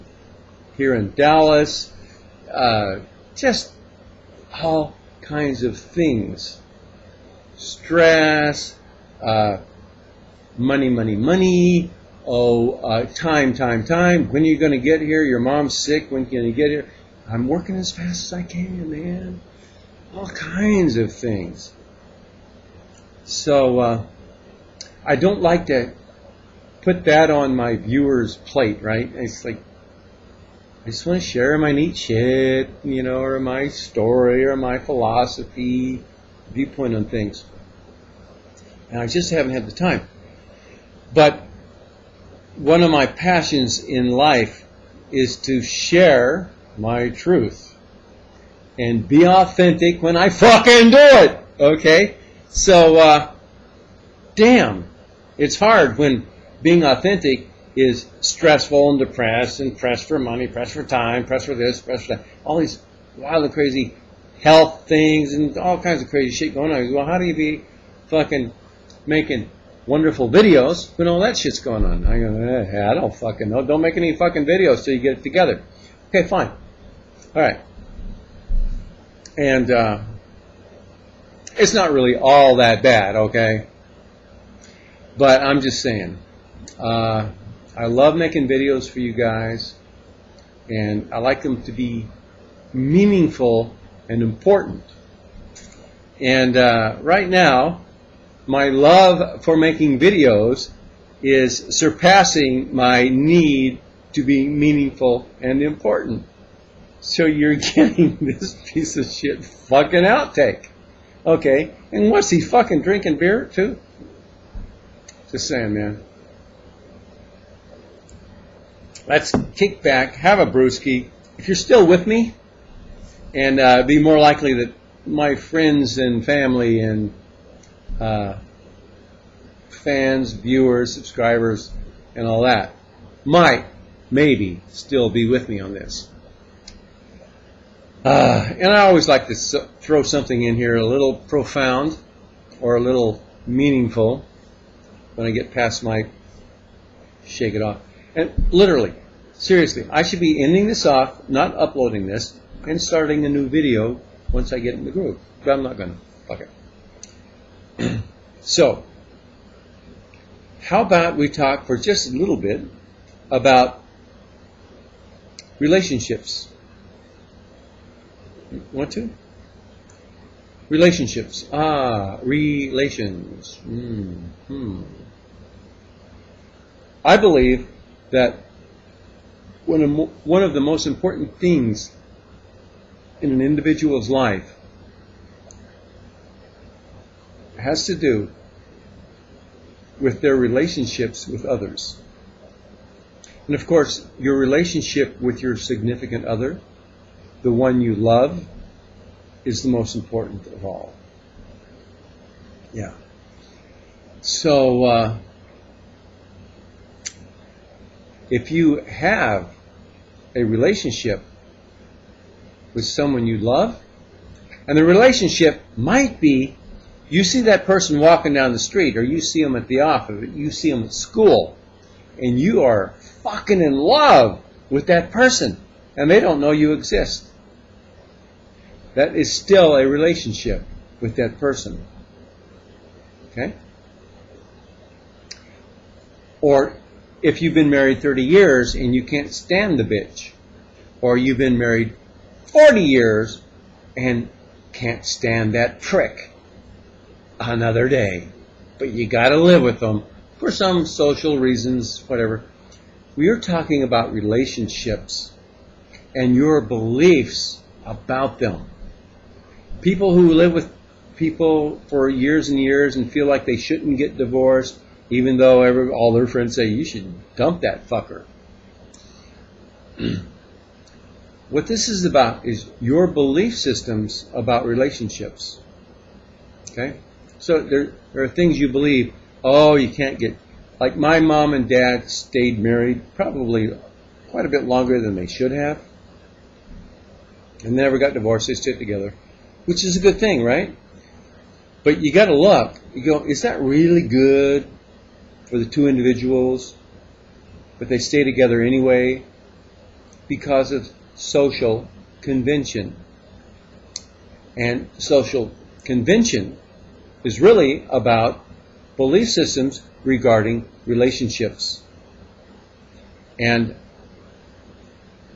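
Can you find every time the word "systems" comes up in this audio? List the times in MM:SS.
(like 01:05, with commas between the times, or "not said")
04:33, 05:09.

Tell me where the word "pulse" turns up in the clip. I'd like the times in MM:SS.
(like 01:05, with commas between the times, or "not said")
not said.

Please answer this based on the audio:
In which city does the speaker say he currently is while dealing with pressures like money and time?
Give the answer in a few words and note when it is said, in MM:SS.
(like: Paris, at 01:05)
Dallas, at 00:01.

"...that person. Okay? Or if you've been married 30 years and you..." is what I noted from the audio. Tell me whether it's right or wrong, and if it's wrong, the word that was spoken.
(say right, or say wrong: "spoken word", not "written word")
right.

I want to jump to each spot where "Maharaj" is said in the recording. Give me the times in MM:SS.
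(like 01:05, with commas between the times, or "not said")
not said.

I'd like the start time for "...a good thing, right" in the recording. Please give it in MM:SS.
04:49.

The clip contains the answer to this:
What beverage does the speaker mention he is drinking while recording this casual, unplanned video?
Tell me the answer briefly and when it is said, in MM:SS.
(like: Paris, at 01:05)
Beer, at 01:53.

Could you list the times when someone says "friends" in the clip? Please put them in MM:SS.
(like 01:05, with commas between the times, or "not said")
02:05, 04:26.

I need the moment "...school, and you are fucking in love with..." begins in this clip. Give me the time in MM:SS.
03:40.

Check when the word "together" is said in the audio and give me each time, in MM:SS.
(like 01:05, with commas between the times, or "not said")
01:15, 04:48, 04:58.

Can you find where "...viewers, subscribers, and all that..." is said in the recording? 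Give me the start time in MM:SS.
02:10.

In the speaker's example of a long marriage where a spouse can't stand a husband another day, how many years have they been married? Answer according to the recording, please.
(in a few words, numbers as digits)
40.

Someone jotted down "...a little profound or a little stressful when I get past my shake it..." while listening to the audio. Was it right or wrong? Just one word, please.
wrong.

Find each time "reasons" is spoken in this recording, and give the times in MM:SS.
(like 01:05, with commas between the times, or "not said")
04:11.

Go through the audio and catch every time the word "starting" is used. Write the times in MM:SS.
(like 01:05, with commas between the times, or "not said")
02:32.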